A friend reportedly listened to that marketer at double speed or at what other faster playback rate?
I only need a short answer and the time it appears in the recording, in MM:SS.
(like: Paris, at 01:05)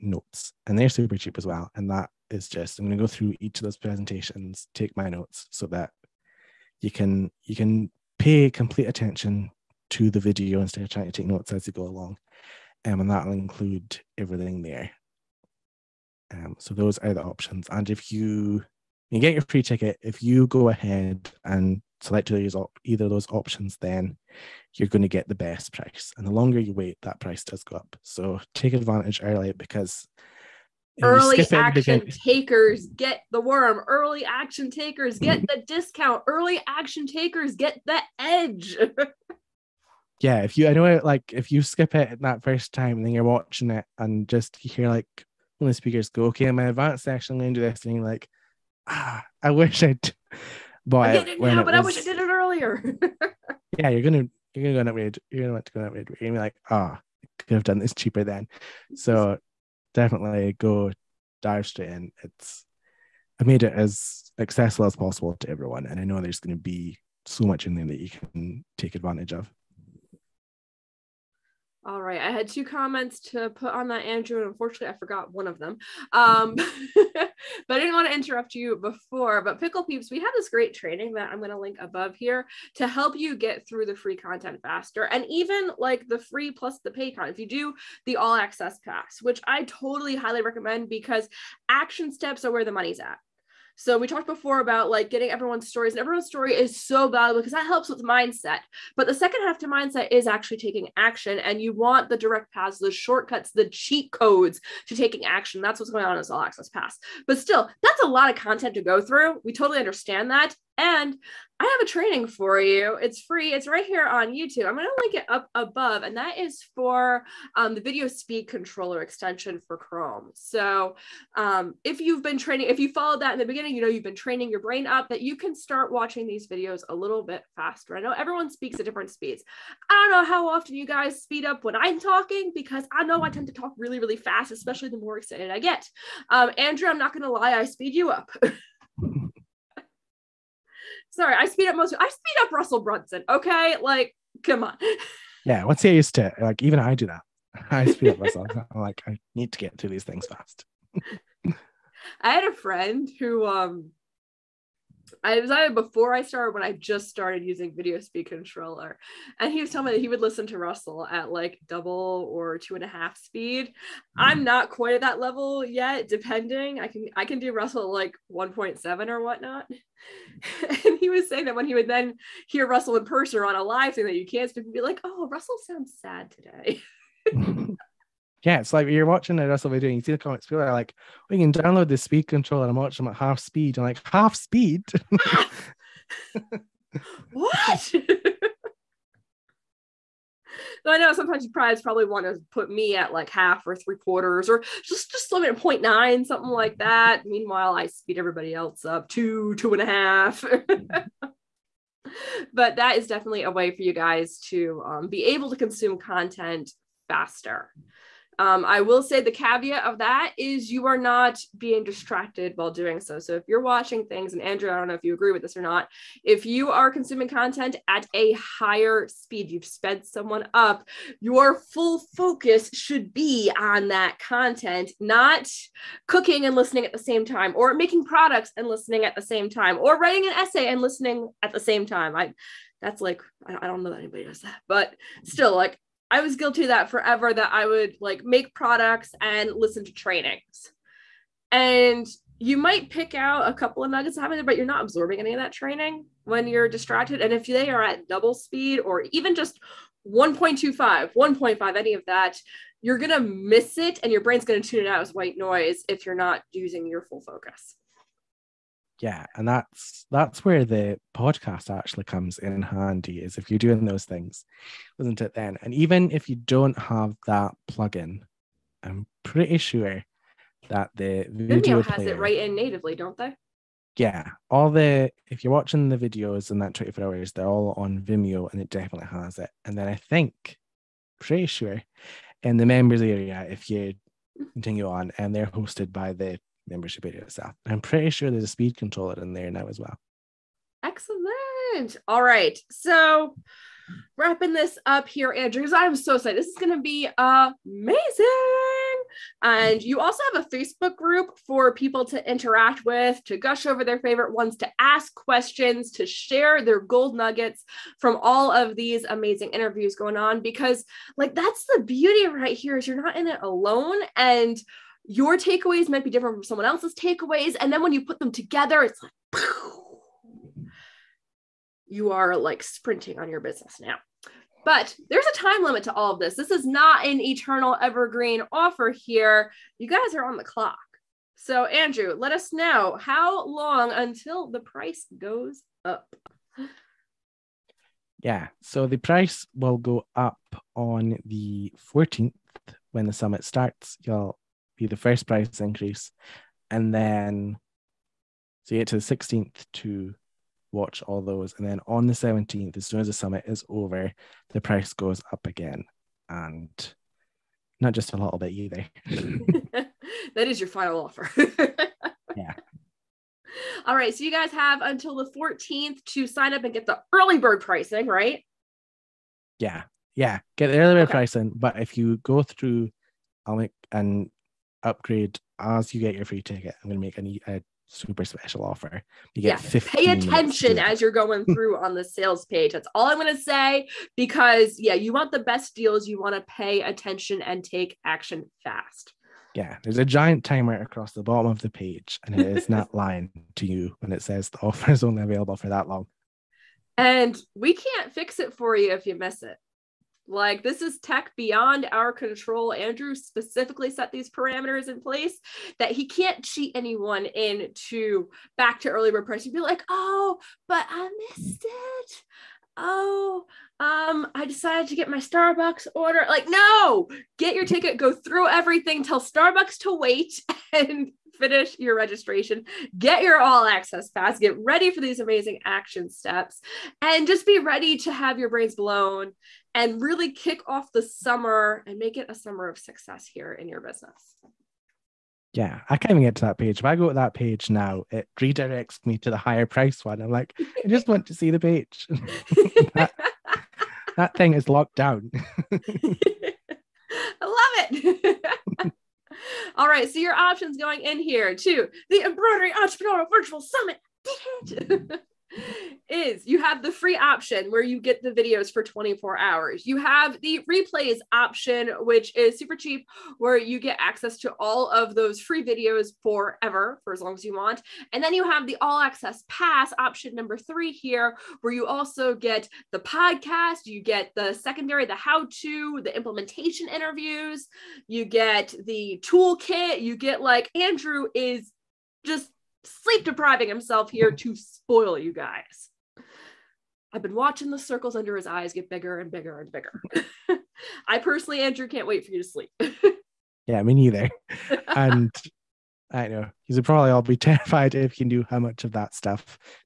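two and a half speed, at 02:42.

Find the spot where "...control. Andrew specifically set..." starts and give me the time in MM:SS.
06:42.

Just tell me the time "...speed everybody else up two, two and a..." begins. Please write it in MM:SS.
03:17.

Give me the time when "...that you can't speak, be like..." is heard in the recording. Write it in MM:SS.
02:54.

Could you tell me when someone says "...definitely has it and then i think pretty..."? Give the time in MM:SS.
04:38.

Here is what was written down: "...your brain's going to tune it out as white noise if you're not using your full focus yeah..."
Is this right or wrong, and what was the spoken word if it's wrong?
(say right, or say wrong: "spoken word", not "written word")
right.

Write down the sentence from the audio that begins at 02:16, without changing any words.
Um, Andrew, I'm not going to lie, I speed you up.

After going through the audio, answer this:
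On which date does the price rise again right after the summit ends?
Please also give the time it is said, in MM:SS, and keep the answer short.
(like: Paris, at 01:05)
the 17th, at 05:52.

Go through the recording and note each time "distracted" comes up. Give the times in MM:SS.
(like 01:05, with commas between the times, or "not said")
03:31, 04:06.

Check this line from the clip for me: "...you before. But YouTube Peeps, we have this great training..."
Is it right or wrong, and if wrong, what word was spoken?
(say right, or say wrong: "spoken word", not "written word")
wrong: "Pikul", not "YouTube".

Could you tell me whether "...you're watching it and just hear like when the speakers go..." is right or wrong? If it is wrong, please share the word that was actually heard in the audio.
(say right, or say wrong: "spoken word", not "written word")
right.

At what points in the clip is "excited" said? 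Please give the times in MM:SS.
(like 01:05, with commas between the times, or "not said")
02:15, 04:56.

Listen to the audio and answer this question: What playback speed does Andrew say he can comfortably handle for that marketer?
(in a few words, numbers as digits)
1.7.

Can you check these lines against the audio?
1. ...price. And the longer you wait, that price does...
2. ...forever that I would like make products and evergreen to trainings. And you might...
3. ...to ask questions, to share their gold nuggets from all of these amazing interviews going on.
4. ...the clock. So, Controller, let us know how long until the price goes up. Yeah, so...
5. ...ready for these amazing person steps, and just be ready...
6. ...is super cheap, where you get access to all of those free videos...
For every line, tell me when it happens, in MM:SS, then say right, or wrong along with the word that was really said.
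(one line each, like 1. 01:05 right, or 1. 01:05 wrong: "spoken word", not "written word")
1. 00:25 right
2. 03:56 wrong: "listen", not "evergreen"
3. 05:04 right
4. 05:30 wrong: "Andrew", not "Controller"
5. 07:04 wrong: "action", not "person"
6. 07:42 right.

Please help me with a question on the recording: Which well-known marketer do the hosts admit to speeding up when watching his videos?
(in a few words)
Russell Brunson.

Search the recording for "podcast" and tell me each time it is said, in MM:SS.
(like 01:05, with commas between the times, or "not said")
04:21, 07:52.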